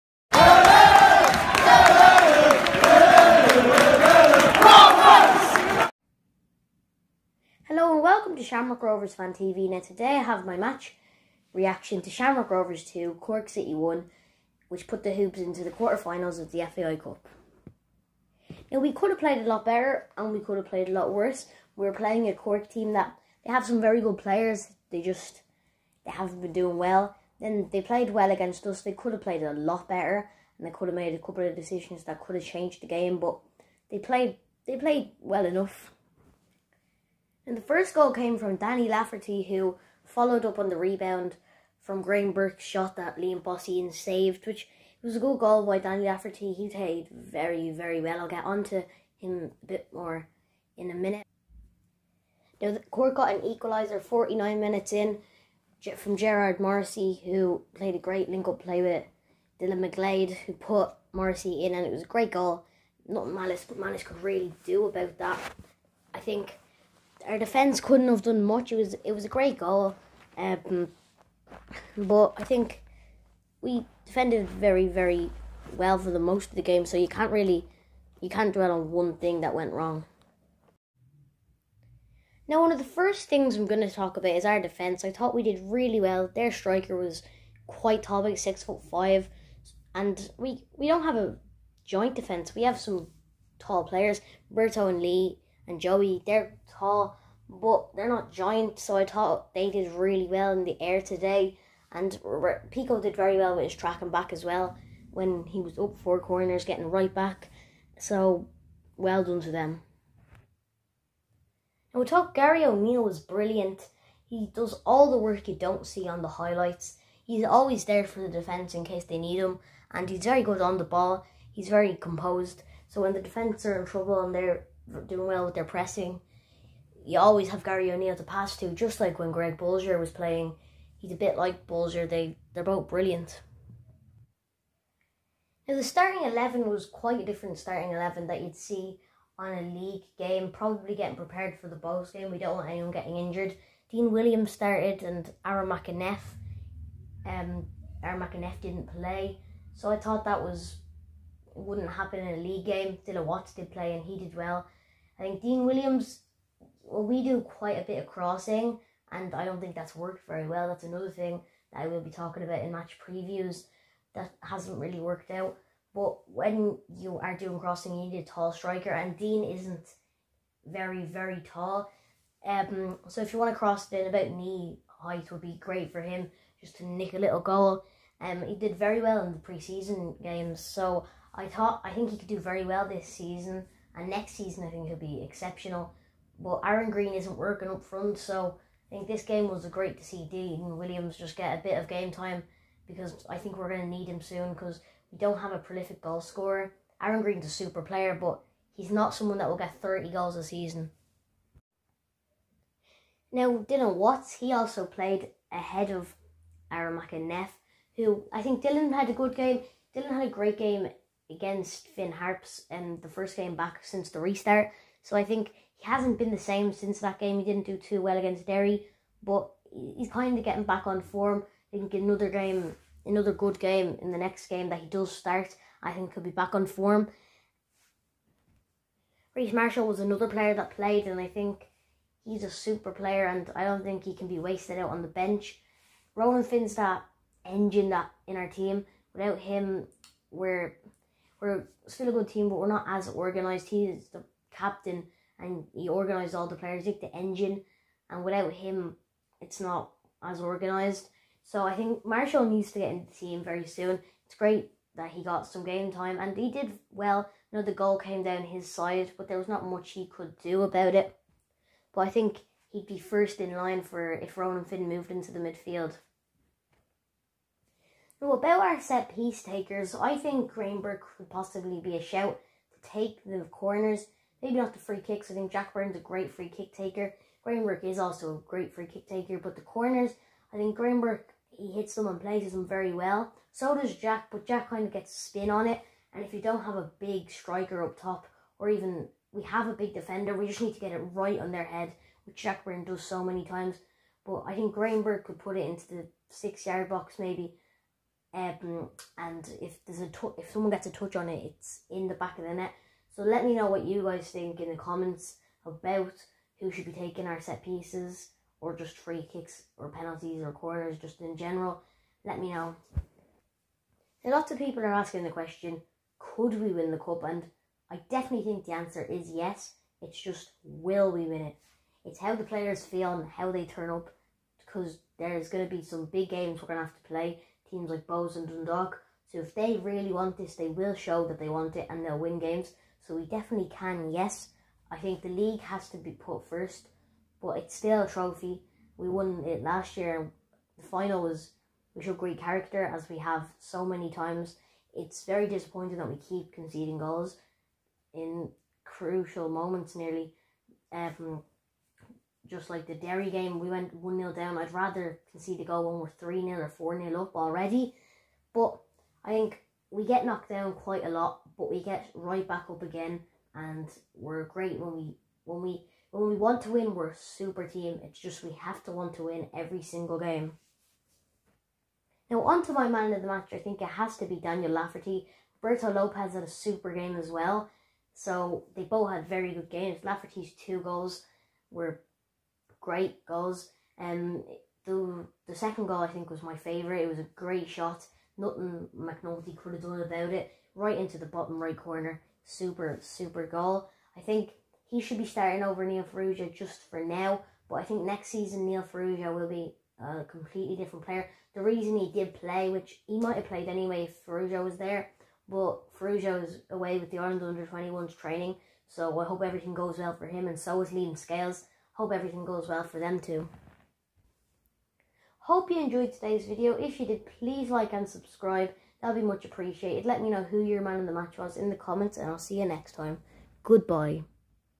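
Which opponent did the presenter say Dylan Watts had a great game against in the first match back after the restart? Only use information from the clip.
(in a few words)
Finn Harps.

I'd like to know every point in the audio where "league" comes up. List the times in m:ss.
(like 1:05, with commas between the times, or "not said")
2:19, 2:32, 5:35.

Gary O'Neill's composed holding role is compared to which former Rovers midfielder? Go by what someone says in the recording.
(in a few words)
Greg Bolger.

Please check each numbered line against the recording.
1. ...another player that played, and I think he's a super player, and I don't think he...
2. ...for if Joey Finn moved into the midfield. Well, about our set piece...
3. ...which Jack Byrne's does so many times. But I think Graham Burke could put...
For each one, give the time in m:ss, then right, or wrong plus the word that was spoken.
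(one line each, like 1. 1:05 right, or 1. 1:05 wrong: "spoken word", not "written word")
1. 3:50 right
2. 4:23 wrong: "Ronan", not "Joey"
3. 4:52 right.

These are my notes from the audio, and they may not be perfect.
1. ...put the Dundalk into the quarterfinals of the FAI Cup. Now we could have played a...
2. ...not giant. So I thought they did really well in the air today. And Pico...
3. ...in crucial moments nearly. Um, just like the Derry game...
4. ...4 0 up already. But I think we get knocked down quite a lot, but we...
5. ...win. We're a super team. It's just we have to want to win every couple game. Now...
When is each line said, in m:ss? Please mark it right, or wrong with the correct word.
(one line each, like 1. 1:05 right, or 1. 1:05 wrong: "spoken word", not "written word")
1. 0:14 wrong: "Hoops", not "Dundalk"
2. 1:38 right
3. 5:48 right
4. 5:56 right
5. 6:06 wrong: "single", not "couple".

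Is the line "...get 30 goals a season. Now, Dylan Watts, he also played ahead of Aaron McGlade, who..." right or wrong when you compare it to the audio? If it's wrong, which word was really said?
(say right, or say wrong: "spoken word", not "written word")
wrong: "Neff", not "McGlade".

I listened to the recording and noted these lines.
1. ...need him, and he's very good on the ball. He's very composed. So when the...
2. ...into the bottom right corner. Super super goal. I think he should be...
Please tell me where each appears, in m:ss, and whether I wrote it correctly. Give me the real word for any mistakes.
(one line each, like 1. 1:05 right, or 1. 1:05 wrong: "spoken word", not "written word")
1. 1:59 right
2. 6:30 right.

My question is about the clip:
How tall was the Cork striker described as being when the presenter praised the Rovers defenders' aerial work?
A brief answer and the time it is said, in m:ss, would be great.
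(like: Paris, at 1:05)
6 foot 5, at 1:28.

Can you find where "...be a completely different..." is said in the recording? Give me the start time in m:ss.
6:39.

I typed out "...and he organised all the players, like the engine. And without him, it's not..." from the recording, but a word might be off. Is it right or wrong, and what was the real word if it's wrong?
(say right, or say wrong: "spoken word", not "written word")
right.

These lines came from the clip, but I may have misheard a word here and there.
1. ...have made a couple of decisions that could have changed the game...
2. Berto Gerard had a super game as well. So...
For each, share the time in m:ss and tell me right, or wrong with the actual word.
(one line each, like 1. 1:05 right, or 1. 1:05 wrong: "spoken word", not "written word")
1. 0:30 right
2. 6:15 wrong: "Lopez", not "Gerard".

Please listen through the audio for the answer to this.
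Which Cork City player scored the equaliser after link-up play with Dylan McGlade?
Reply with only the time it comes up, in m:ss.
0:56.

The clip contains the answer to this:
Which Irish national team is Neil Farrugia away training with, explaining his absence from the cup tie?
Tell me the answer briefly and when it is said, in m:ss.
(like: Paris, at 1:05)
Ireland under 21s, at 6:47.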